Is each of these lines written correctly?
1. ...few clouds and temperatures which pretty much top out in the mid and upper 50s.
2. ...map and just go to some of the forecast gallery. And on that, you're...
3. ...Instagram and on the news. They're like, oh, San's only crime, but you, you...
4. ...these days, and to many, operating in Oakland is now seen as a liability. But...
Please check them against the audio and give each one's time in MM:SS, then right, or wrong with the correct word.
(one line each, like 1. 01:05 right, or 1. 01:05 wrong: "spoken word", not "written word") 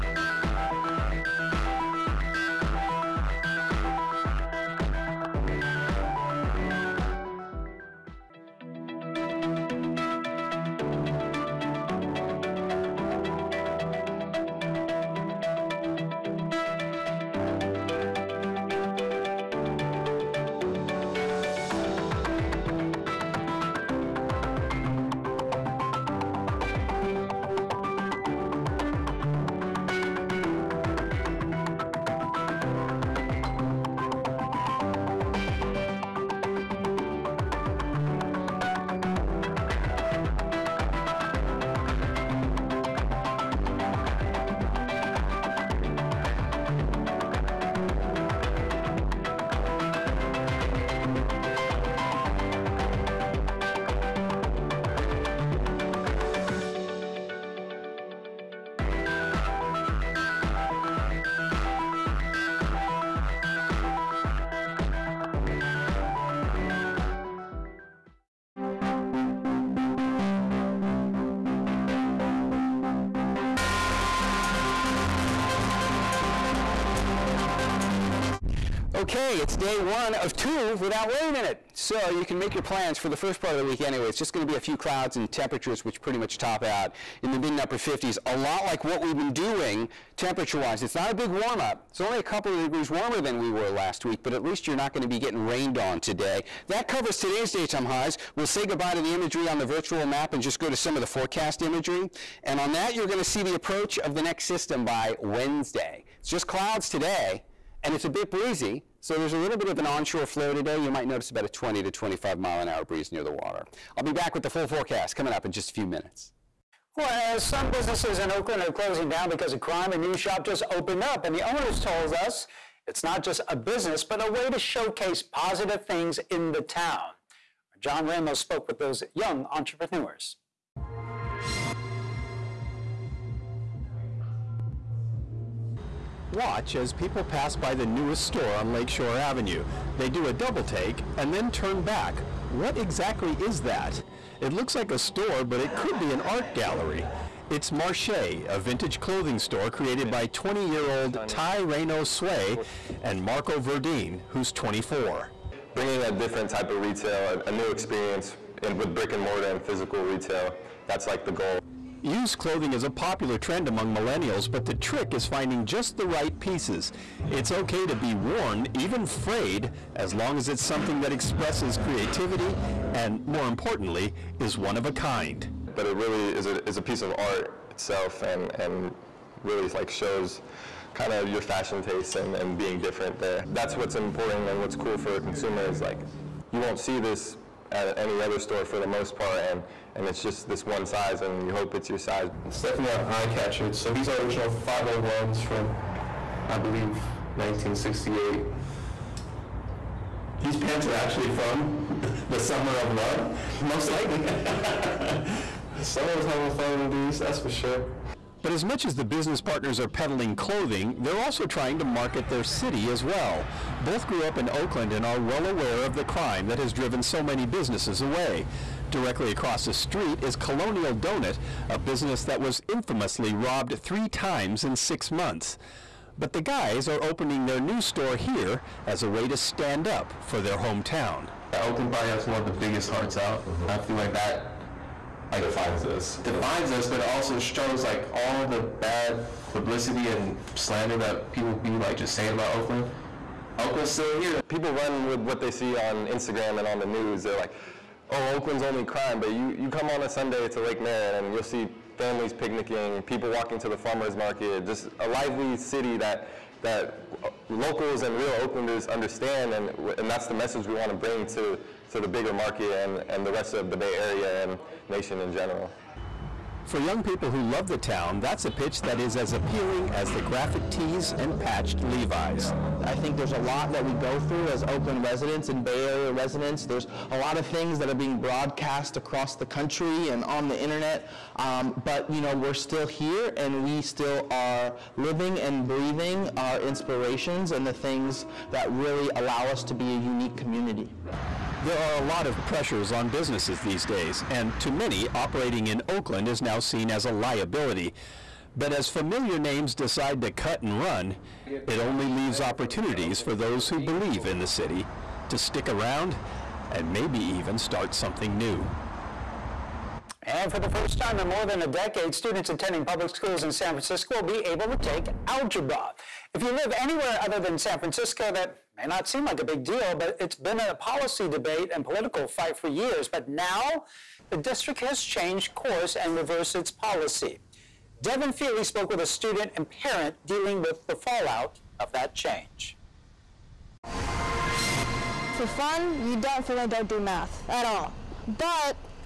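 1. 01:24 right
2. 01:40 wrong: "imagery", not "gallery"
3. 04:06 wrong: "Oakland", not "San"
4. 04:53 right.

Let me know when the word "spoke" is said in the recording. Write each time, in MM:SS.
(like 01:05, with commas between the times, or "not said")
02:08, 05:28.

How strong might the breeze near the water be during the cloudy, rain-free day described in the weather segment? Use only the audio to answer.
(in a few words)
20 to 25 mph.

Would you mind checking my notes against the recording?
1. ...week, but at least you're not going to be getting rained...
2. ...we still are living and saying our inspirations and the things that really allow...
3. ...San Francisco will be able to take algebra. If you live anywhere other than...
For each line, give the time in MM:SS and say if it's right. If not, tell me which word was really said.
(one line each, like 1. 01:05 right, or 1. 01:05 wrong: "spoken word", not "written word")
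1. 01:34 right
2. 04:43 wrong: "breathing", not "saying"
3. 05:13 right.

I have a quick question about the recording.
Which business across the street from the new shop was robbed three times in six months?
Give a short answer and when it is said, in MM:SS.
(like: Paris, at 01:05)
Colonial Donut, at 03:40.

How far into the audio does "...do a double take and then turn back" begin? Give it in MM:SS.
02:20.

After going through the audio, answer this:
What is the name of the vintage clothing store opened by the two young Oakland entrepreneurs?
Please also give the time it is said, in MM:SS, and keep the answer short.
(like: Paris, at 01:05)
Marché, at 02:27.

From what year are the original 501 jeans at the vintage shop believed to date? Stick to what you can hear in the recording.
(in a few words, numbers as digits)
1968.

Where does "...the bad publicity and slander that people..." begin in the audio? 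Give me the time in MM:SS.
03:58.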